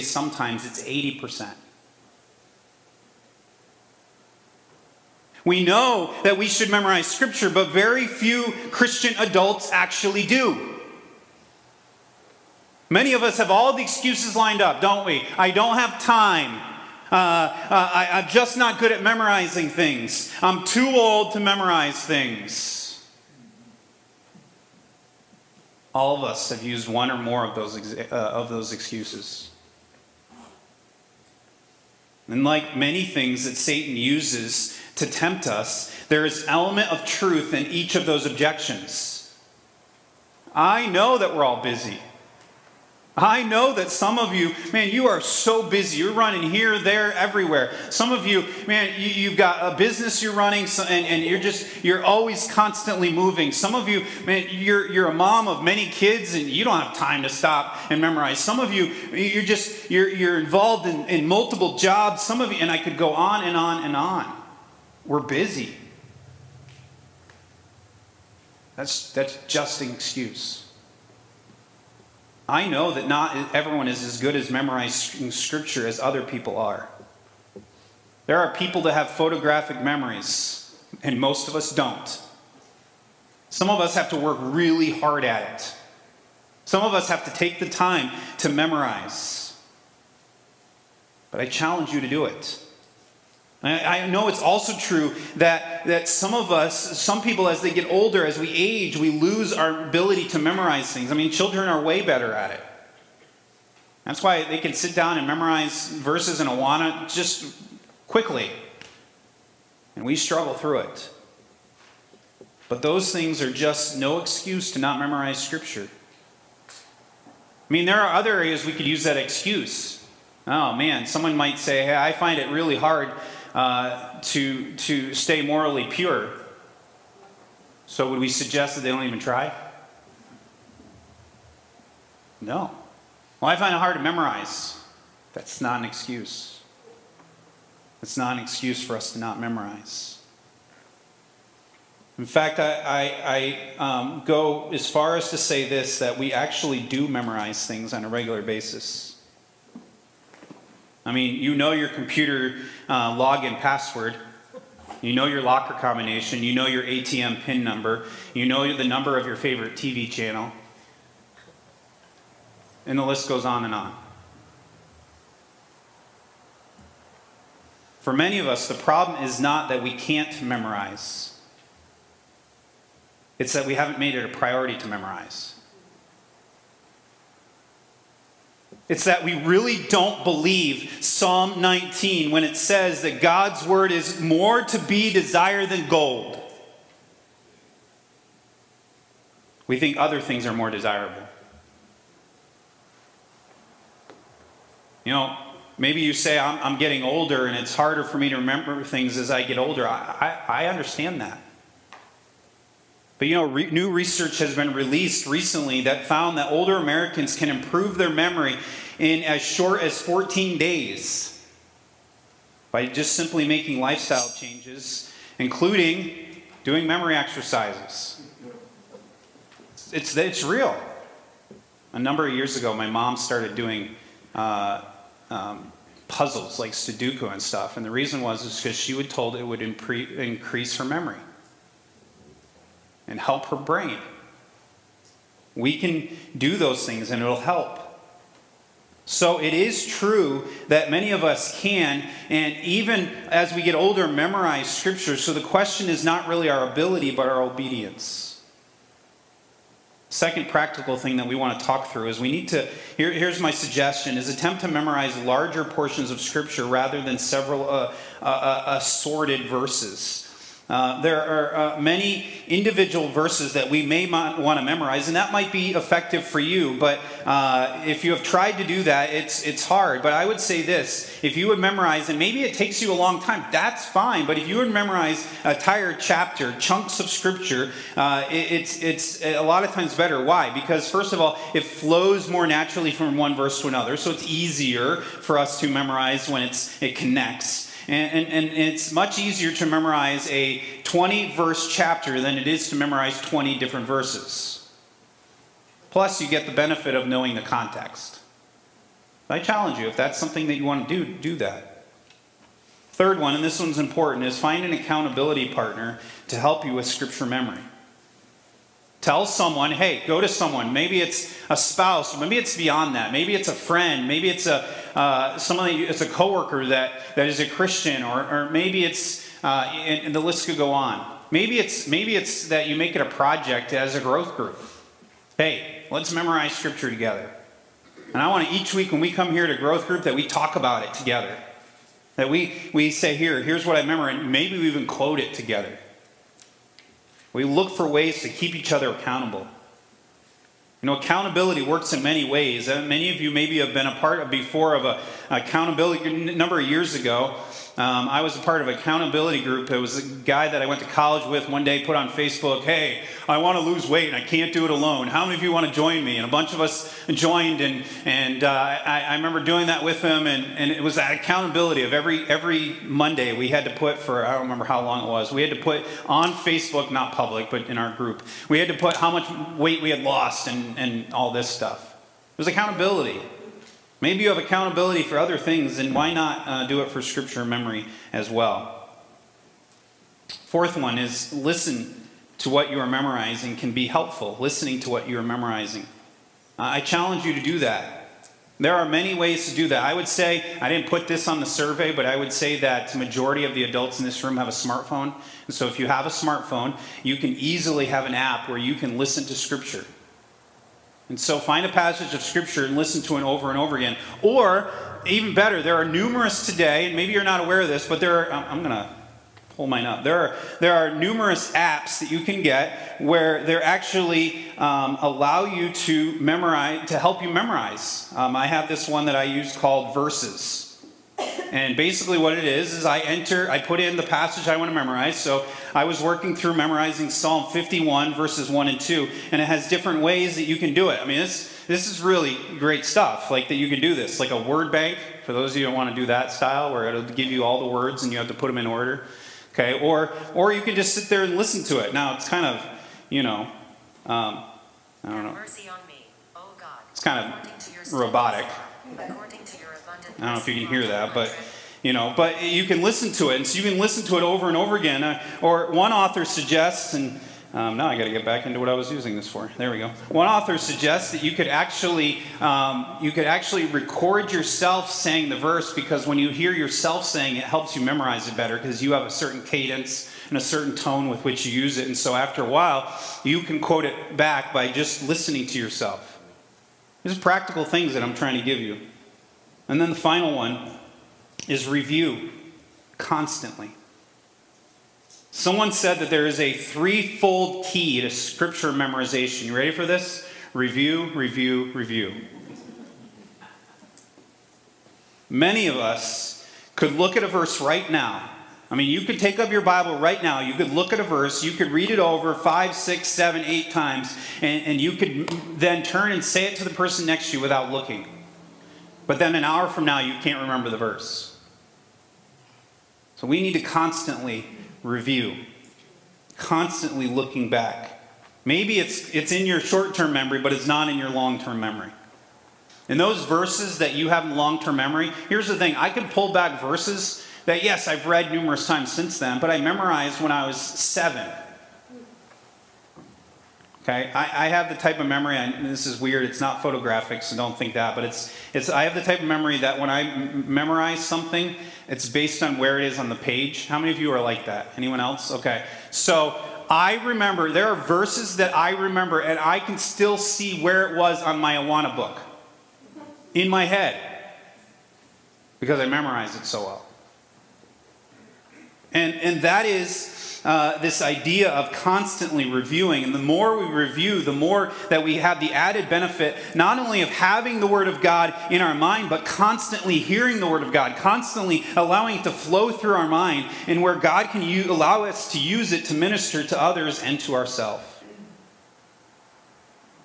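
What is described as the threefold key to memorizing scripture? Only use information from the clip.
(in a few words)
Review, review, review.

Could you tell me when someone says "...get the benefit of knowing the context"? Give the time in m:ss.
4:56.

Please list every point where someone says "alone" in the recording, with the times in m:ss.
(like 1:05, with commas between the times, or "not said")
5:54.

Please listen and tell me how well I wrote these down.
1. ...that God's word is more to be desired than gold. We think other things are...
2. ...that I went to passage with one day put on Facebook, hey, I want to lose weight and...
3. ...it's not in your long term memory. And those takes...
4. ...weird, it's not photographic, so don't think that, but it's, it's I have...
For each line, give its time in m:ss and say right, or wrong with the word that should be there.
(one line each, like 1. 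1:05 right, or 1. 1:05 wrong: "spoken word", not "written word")
1. 3:03 right
2. 5:50 wrong: "college", not "passage"
3. 8:40 wrong: "verses", not "takes"
4. 8:55 right.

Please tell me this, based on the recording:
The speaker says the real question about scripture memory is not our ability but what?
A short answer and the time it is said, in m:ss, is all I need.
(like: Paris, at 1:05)
Our obedience, at 4:07.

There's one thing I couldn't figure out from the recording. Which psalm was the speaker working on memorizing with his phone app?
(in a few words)
Psalm 51.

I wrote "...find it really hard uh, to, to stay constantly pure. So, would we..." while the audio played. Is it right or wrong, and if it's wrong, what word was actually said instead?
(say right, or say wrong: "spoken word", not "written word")
wrong: "morally", not "constantly".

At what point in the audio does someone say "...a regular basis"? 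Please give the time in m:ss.
2:28.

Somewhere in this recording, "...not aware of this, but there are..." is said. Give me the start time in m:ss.
6:47.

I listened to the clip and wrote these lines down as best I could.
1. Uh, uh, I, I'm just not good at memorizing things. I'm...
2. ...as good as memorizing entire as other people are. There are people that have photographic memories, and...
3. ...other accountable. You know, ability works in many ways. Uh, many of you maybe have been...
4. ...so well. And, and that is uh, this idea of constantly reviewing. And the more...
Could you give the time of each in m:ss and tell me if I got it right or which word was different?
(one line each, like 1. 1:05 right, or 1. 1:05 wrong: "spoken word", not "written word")
1. 0:17 right
2. 1:14 wrong: "scripture", not "entire"
3. 5:38 wrong: "accountability", not "ability"
4. 9:16 right.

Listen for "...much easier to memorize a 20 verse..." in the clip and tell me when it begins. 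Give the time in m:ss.
4:48.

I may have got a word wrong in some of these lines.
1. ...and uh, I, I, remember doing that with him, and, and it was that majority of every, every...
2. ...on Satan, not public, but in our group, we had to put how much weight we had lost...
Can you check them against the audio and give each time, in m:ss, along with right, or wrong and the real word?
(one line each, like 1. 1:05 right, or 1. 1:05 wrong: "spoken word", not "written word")
1. 5:58 wrong: "accountability", not "majority"
2. 6:06 wrong: "Facebook", not "Satan".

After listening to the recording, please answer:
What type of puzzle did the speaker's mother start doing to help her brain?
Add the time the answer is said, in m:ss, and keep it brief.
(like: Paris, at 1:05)
Sudoku, at 3:46.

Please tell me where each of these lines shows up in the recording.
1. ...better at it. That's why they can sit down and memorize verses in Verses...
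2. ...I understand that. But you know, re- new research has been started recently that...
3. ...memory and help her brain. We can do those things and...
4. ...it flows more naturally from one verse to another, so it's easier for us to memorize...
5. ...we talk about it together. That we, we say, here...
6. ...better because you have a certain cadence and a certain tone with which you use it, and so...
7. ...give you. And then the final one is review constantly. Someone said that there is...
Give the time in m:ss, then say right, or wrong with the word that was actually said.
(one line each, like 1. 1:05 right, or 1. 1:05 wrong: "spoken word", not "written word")
1. 1:42 wrong: "Awana", not "Verses"
2. 3:20 wrong: "released", not "started"
3. 3:50 right
4. 4:41 right
5. 5:30 right
6. 7:48 right
7. 7:58 right.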